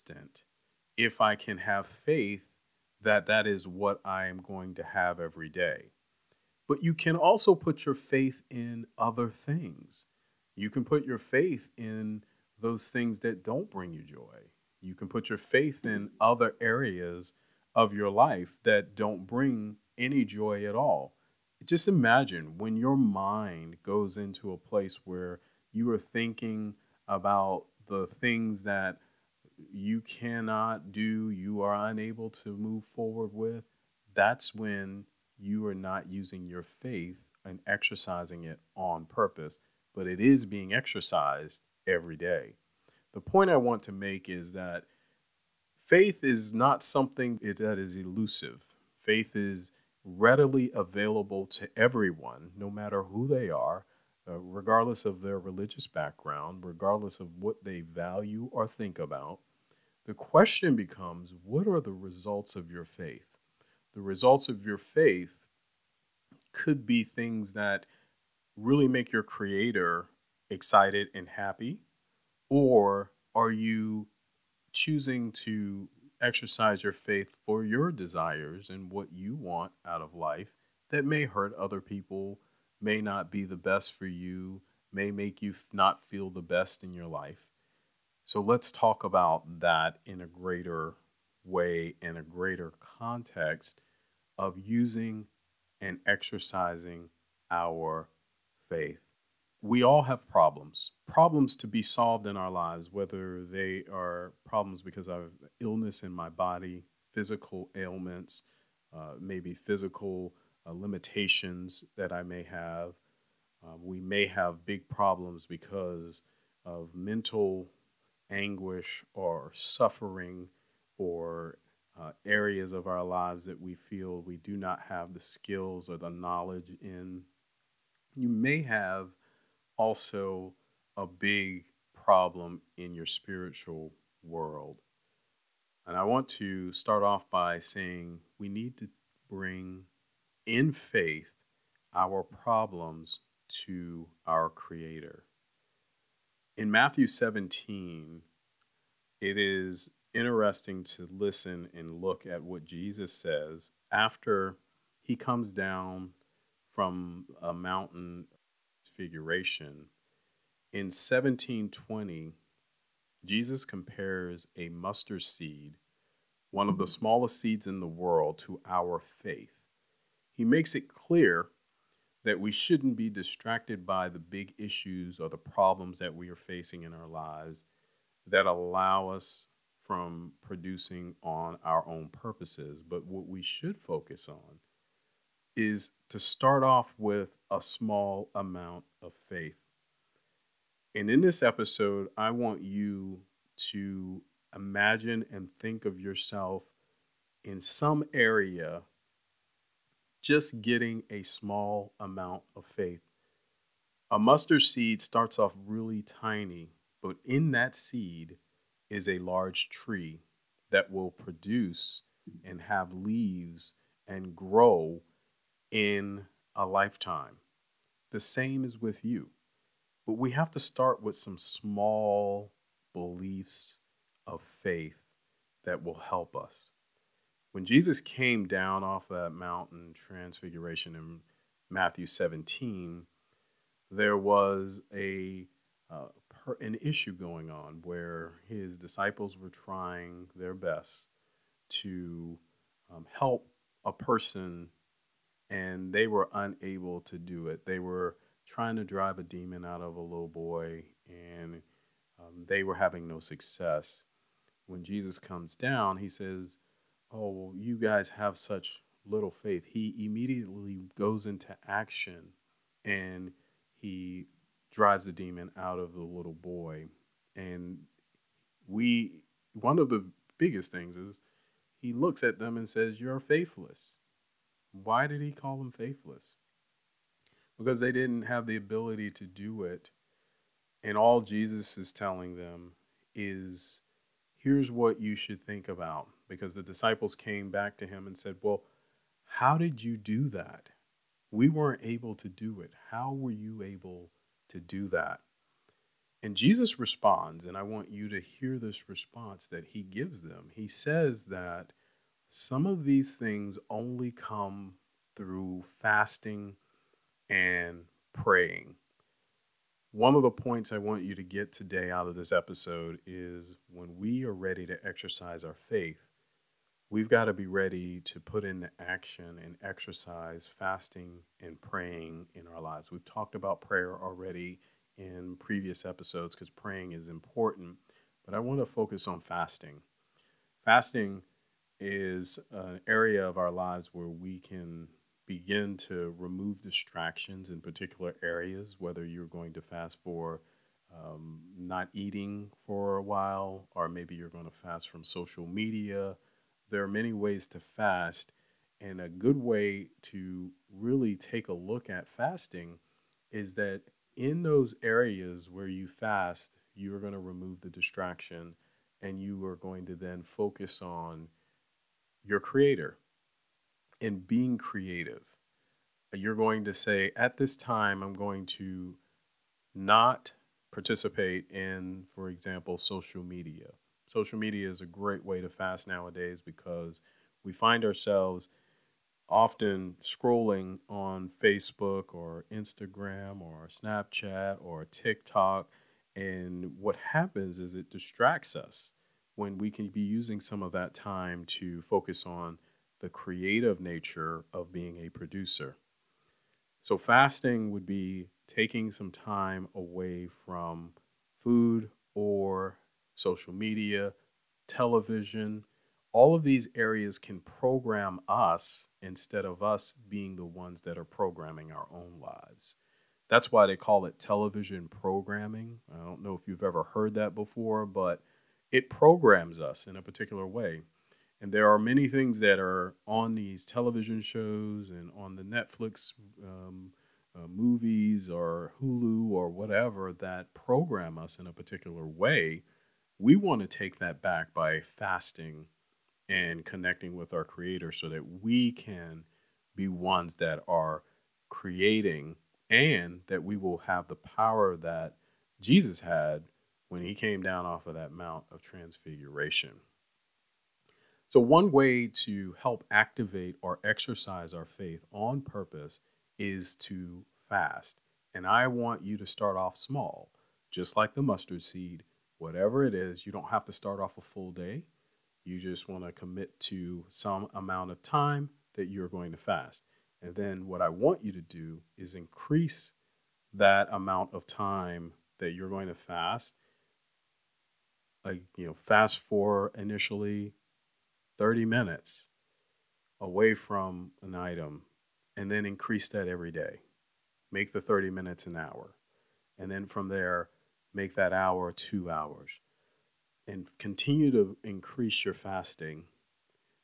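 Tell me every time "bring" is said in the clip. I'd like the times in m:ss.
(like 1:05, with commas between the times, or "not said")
0:13, 0:19, 2:19.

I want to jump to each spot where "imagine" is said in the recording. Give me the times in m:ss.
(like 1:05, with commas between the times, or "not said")
0:21, 3:14.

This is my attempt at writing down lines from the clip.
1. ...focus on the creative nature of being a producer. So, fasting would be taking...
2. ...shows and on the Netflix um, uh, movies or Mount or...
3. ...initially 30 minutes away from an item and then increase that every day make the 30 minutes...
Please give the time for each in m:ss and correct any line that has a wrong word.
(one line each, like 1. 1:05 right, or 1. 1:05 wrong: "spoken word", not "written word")
1. 6:31 right
2. 7:04 wrong: "Hulu", not "Mount"
3. 7:59 right.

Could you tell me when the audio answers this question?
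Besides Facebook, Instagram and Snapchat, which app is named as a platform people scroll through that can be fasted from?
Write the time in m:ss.
6:24.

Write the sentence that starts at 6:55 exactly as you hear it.
I don't know if you've ever heard that before, but it programs us in a particular way.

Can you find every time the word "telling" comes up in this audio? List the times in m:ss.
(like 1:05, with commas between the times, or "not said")
4:41.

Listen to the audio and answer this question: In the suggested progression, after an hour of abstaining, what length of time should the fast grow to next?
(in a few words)
2 hours.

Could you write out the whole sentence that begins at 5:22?
We've talked about prayer already in previous episodes because praying is important, but I want to focus on fasting.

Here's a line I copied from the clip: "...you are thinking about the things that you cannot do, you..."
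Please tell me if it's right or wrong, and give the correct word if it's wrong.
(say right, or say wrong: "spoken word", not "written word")
right.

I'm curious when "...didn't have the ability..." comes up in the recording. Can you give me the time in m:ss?
4:37.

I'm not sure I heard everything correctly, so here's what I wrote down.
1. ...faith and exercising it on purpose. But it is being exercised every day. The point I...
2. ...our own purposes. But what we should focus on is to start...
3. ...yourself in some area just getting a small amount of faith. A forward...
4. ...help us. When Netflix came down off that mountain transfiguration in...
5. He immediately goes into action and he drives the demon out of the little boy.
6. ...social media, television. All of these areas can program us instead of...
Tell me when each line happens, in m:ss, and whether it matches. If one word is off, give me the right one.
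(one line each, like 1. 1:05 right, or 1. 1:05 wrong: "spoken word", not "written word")
1. 0:36 right
2. 3:01 right
3. 3:15 wrong: "mustard", not "forward"
4. 3:45 wrong: "Jesus", not "Netflix"
5. 4:19 right
6. 6:43 right.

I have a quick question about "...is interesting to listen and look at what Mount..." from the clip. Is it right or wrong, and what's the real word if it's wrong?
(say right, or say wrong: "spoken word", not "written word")
wrong: "Jesus", not "Mount".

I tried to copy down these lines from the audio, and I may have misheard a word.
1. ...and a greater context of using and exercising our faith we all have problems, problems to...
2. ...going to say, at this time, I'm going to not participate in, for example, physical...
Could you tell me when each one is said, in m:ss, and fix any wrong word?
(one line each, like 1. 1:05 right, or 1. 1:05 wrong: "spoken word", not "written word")
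1. 1:32 right
2. 6:06 wrong: "social", not "physical".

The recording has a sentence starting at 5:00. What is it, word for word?
He says that some of these things only come through fasting and praying.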